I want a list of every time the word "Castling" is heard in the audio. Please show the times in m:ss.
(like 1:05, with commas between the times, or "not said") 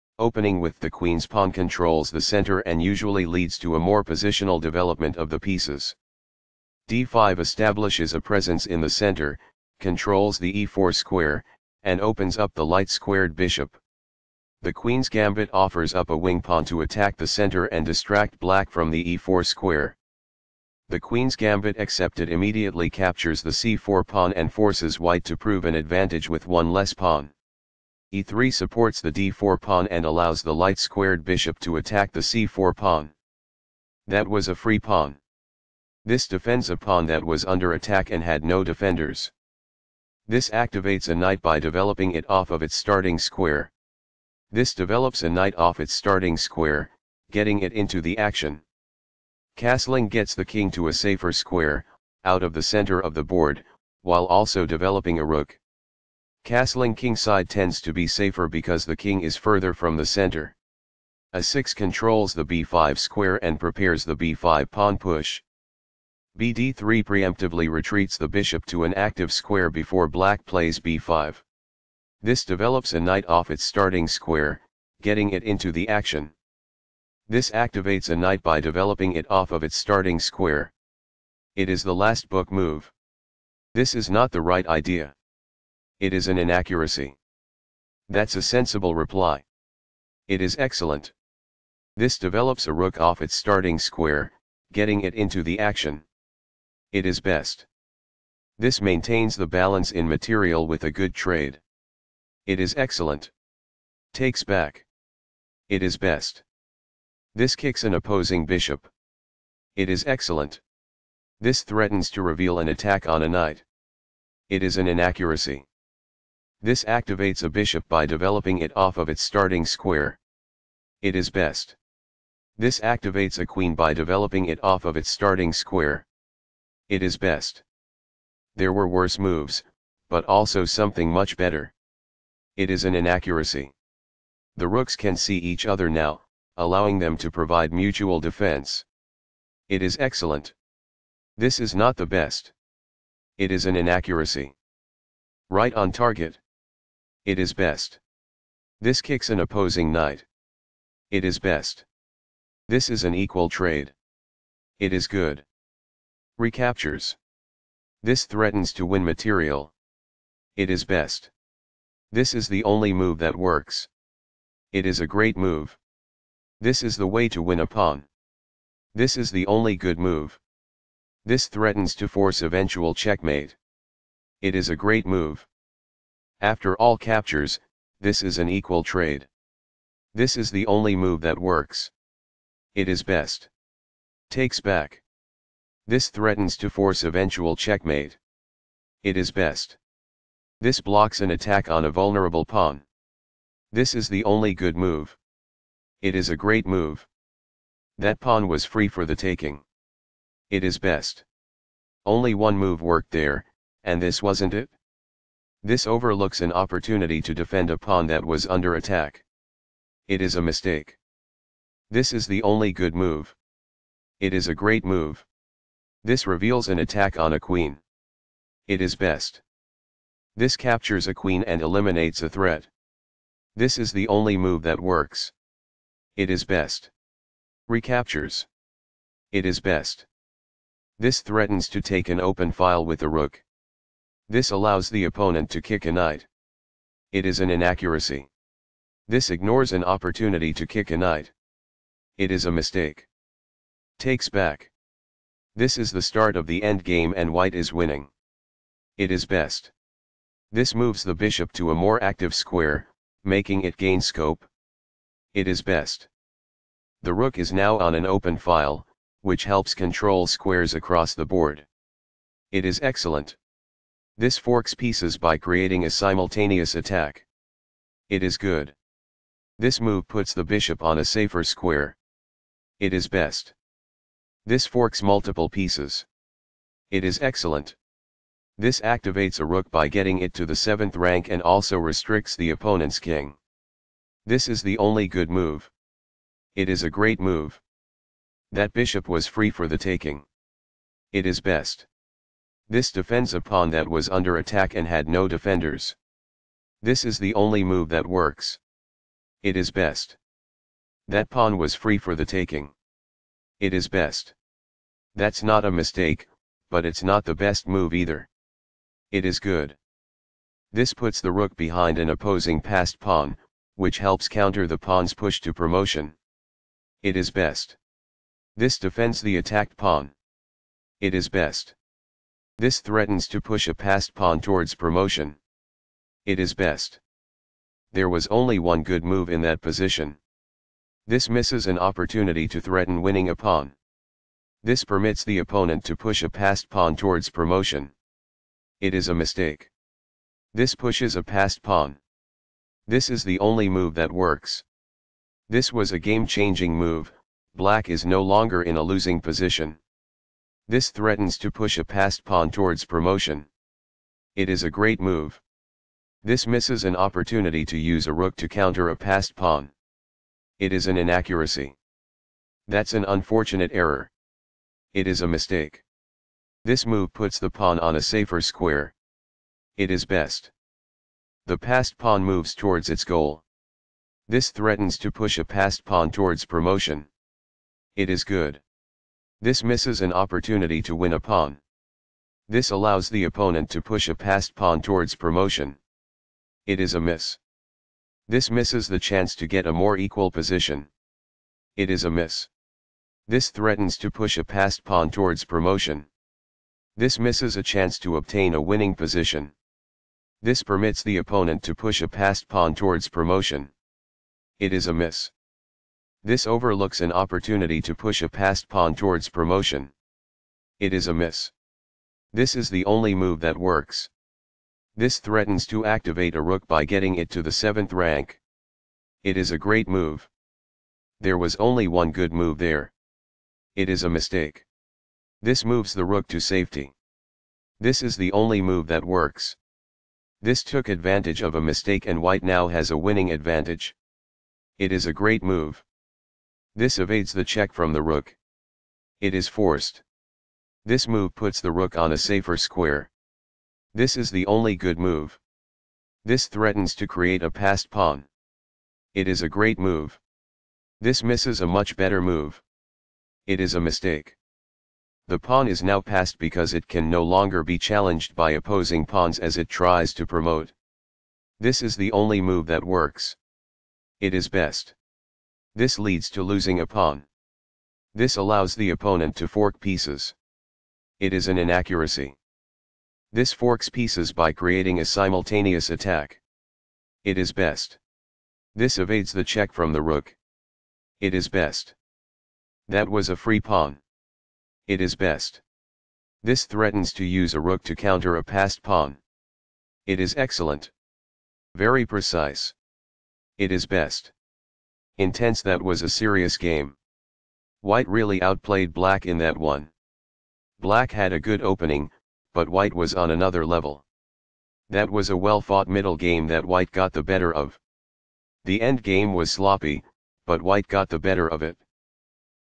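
0:49, 0:56.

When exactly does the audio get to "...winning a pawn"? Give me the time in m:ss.
5:33.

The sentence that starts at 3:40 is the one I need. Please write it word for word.
This captures a queen and eliminates a threat.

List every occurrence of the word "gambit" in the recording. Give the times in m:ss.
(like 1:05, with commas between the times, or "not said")
0:15, 0:21.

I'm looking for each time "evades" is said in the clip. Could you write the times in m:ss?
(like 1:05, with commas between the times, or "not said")
7:16, 7:58.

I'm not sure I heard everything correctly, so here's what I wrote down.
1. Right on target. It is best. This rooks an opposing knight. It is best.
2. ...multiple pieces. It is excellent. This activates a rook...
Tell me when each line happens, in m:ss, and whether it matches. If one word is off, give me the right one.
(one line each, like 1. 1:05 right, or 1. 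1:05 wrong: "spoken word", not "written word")
1. 2:25 wrong: "kicks", not "rooks"
2. 4:35 right.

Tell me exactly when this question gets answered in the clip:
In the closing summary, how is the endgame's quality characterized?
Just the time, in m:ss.
8:29.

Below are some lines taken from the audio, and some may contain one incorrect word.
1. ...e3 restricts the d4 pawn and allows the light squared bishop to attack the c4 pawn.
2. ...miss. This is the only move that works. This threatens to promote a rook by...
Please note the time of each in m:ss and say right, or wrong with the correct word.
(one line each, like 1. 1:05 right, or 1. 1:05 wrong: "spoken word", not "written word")
1. 0:28 wrong: "supports", not "restricts"
2. 6:51 wrong: "activate", not "promote".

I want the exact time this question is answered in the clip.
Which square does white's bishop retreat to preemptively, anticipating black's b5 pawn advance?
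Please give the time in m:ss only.
1:06.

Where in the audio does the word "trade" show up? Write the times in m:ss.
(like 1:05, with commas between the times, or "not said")
1:41, 2:33, 2:58.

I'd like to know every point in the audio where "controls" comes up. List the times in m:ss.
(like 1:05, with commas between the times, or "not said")
0:01, 0:09, 1:01, 4:19.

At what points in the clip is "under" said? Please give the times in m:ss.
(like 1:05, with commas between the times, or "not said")
0:37, 3:28, 4:54.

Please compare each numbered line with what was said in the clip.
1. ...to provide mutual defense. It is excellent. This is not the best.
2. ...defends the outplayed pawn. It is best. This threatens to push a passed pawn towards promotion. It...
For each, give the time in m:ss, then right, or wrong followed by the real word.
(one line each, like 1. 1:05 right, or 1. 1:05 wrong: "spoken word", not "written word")
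1. 2:17 right
2. 5:18 wrong: "attacked", not "outplayed".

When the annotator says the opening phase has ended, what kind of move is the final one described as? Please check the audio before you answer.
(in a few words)
the last book move.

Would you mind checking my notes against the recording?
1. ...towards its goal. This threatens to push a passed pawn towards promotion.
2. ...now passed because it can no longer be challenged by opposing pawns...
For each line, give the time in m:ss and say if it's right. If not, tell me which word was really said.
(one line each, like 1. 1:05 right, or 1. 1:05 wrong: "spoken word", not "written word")
1. 6:12 right
2. 7:35 right.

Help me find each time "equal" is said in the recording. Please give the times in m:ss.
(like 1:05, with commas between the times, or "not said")
2:33, 2:58, 6:29.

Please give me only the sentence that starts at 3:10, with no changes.
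This blocks an attack on a vulnerable pawn.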